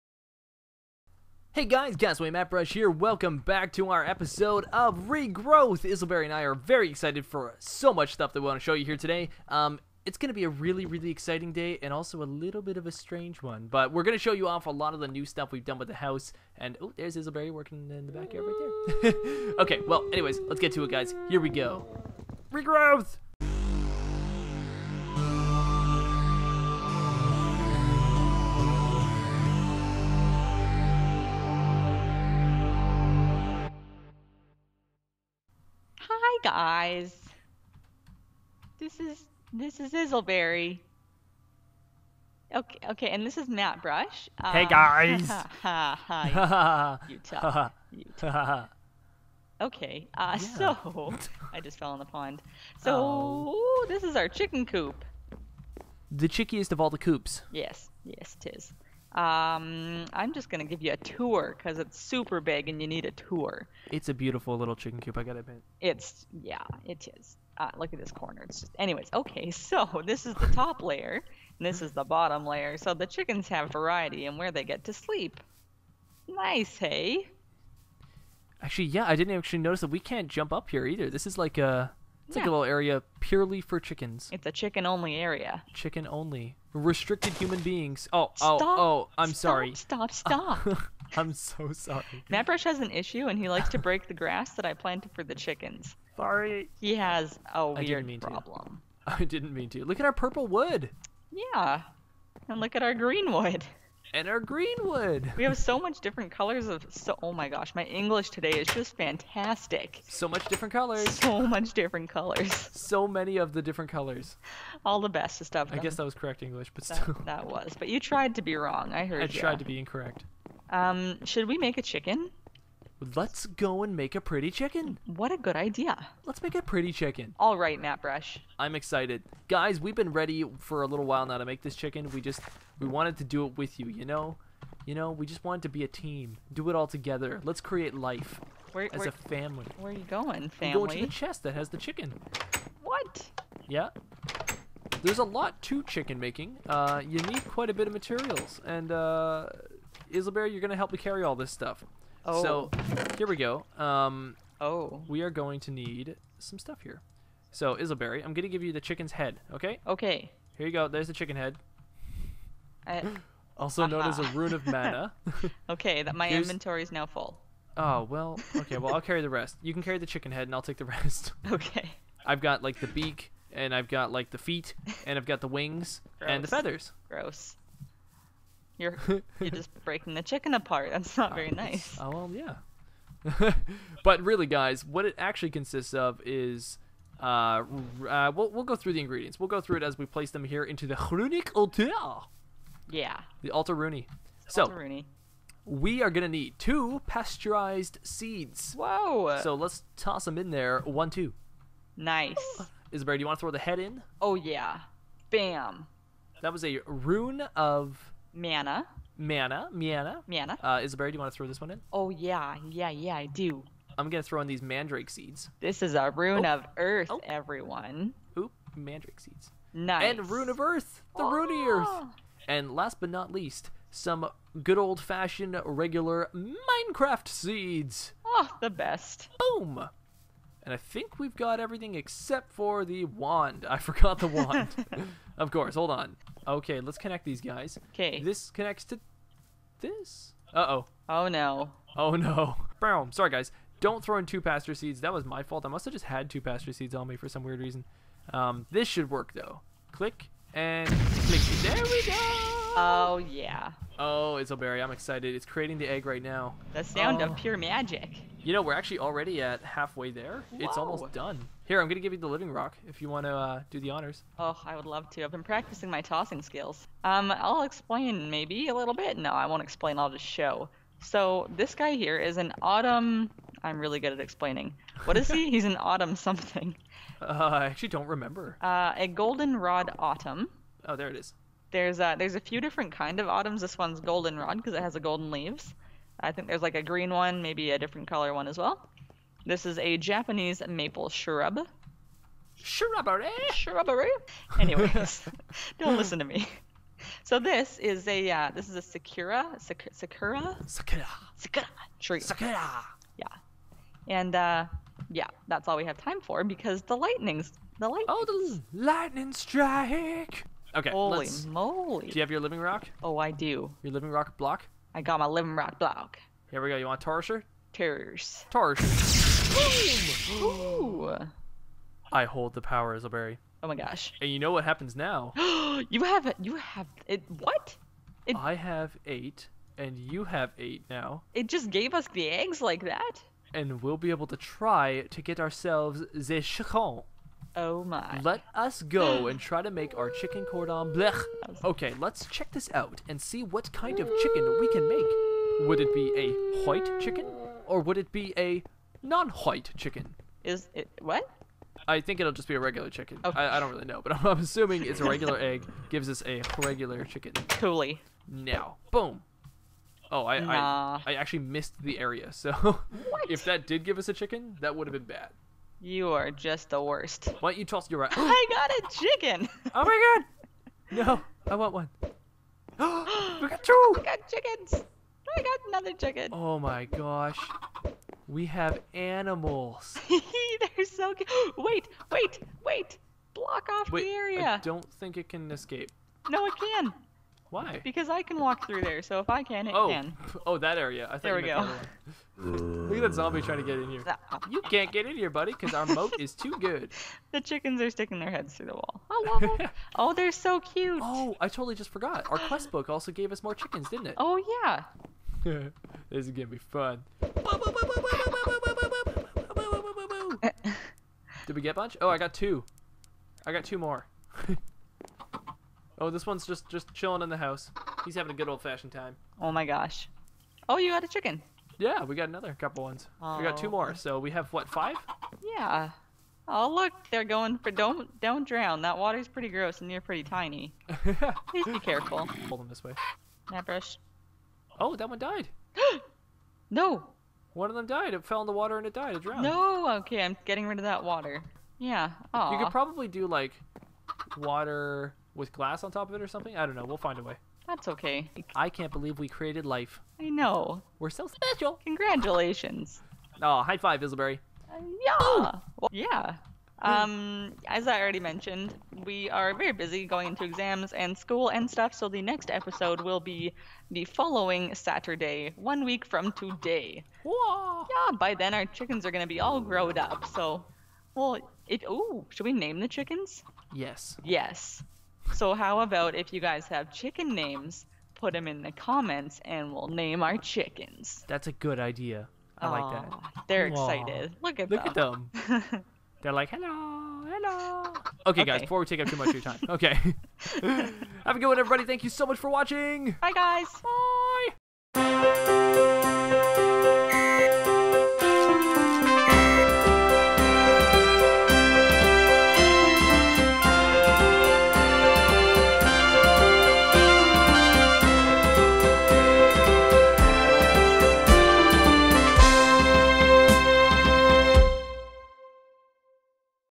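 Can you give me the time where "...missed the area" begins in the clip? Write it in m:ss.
6:01.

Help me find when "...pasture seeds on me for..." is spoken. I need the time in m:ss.
4:06.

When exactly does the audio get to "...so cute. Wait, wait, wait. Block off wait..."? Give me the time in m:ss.
6:20.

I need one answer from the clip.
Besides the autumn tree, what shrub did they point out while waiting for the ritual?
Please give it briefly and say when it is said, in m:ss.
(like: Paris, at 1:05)
Japanese maple, at 4:49.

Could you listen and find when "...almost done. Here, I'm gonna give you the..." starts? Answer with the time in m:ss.
4:20.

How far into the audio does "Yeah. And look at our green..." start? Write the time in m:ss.
1:41.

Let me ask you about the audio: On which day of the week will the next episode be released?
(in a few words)
Saturday.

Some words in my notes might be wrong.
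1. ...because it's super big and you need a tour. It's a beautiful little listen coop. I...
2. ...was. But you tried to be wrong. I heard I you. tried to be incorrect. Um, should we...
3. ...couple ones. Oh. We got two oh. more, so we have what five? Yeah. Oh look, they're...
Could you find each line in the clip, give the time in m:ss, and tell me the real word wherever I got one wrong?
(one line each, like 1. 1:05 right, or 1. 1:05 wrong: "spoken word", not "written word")
1. 1:01 wrong: "chicken", not "listen"
2. 1:57 right
3. 7:02 right.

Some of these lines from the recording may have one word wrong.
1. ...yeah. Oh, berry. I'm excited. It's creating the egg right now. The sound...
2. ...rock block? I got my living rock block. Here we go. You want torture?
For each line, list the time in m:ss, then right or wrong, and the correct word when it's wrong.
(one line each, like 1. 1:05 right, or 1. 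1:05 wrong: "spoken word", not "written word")
1. 4:13 right
2. 5:14 right.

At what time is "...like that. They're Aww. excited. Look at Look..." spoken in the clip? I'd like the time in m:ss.
8:02.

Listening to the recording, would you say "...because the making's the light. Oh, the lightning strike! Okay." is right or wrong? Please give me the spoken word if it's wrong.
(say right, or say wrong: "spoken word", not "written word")
wrong: "lightning", not "making".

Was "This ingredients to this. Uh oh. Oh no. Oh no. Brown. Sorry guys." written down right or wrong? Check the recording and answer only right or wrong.
wrong.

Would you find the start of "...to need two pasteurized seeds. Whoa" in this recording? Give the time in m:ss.
3:16.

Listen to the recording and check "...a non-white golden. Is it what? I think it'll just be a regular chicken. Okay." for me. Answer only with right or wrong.
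wrong.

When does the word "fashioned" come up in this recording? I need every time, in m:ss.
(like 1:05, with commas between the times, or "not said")
3:44, 6:58.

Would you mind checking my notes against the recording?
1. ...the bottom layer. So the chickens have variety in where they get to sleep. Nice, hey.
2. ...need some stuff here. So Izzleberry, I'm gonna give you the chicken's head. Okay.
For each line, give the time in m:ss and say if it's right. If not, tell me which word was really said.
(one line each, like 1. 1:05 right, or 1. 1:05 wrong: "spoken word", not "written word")
1. 1:11 right
2. 2:35 right.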